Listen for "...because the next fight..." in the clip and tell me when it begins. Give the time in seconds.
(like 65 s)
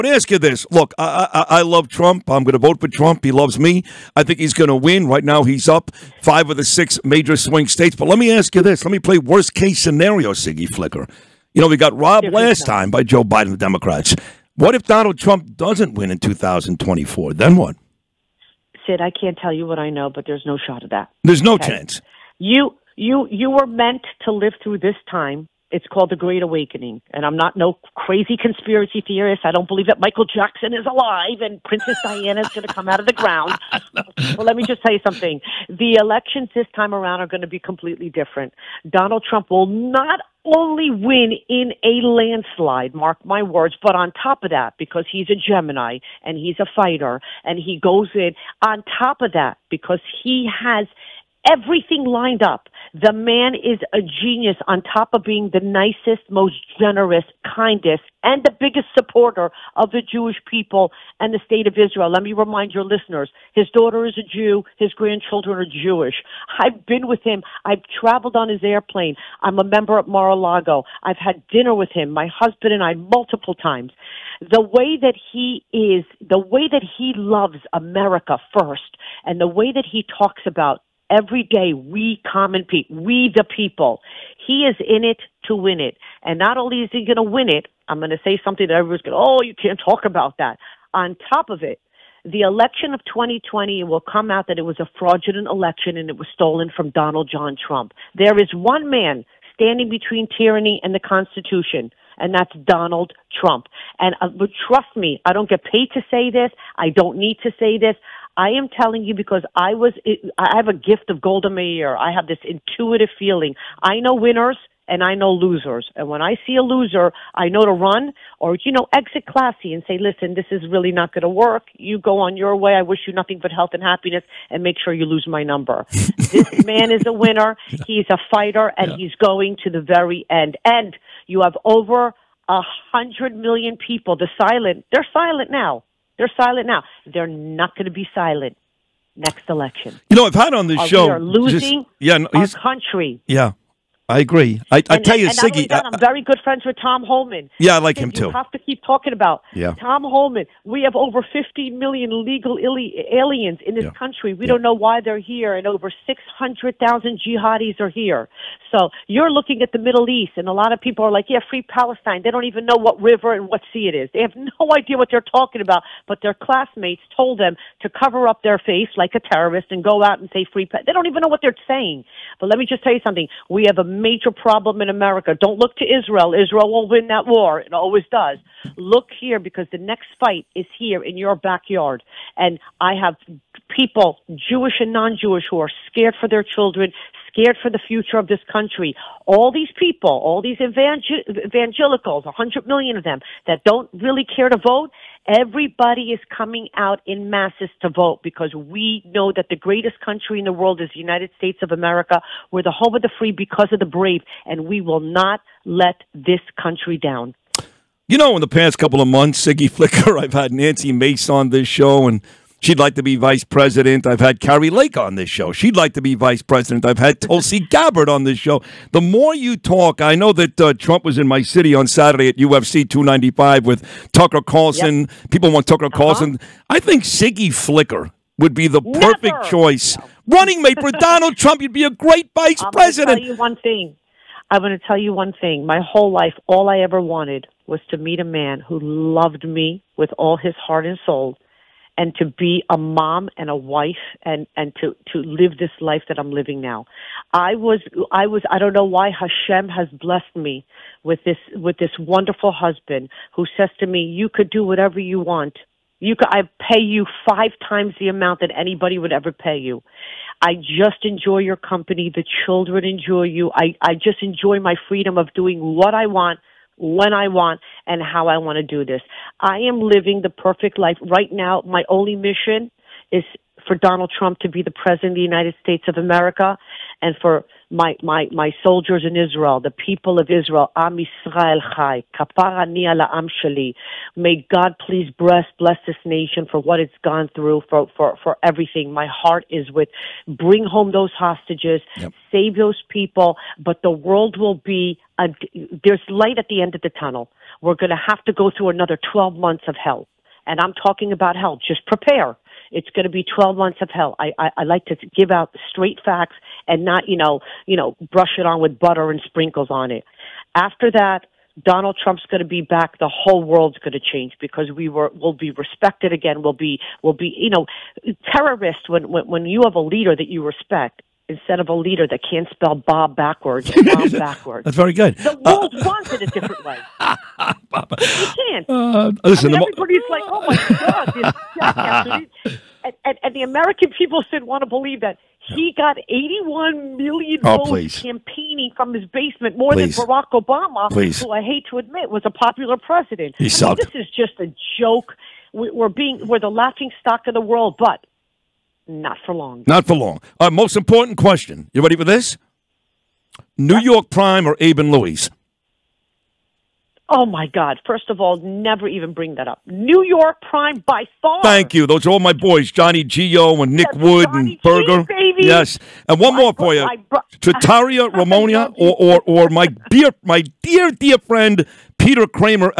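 179 s.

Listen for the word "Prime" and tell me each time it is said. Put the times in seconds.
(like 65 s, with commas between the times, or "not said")
354 s, 360 s.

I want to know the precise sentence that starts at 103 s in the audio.
And uh, trust me, I don't get paid to say this.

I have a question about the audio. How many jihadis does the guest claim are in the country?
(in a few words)
600,000.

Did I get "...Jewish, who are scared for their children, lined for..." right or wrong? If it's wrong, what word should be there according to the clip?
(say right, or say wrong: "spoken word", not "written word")
wrong: "scared", not "lined".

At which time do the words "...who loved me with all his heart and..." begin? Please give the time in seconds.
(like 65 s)
238 s.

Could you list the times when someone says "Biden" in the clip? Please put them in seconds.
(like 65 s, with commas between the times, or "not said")
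13 s.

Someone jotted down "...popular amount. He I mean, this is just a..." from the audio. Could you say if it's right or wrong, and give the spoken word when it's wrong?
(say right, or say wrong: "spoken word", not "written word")
wrong: "president", not "amount".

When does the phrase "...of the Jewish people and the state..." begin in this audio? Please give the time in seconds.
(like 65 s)
59 s.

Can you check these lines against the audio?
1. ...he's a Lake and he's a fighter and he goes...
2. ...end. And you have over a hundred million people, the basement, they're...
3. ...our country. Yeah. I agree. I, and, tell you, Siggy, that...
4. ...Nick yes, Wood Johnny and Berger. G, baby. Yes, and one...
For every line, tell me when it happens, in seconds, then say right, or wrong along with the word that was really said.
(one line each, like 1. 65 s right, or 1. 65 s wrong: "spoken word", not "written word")
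1. 45 s wrong: "Gemini", not "Lake"
2. 130 s wrong: "silent", not "basement"
3. 142 s right
4. 363 s right.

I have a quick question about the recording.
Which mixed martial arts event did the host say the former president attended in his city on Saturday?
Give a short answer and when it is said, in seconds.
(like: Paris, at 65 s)
UFC 295, at 222 s.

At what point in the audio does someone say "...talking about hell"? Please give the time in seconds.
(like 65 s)
300 s.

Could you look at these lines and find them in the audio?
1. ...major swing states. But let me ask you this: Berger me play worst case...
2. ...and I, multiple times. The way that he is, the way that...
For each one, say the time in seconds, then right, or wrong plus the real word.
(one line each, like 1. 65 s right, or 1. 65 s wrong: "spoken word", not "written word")
1. 7 s wrong: "Let", not "Berger"
2. 72 s right.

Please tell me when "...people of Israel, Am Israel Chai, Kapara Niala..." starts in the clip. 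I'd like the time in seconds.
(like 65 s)
279 s.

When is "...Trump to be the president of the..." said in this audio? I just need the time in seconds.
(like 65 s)
274 s.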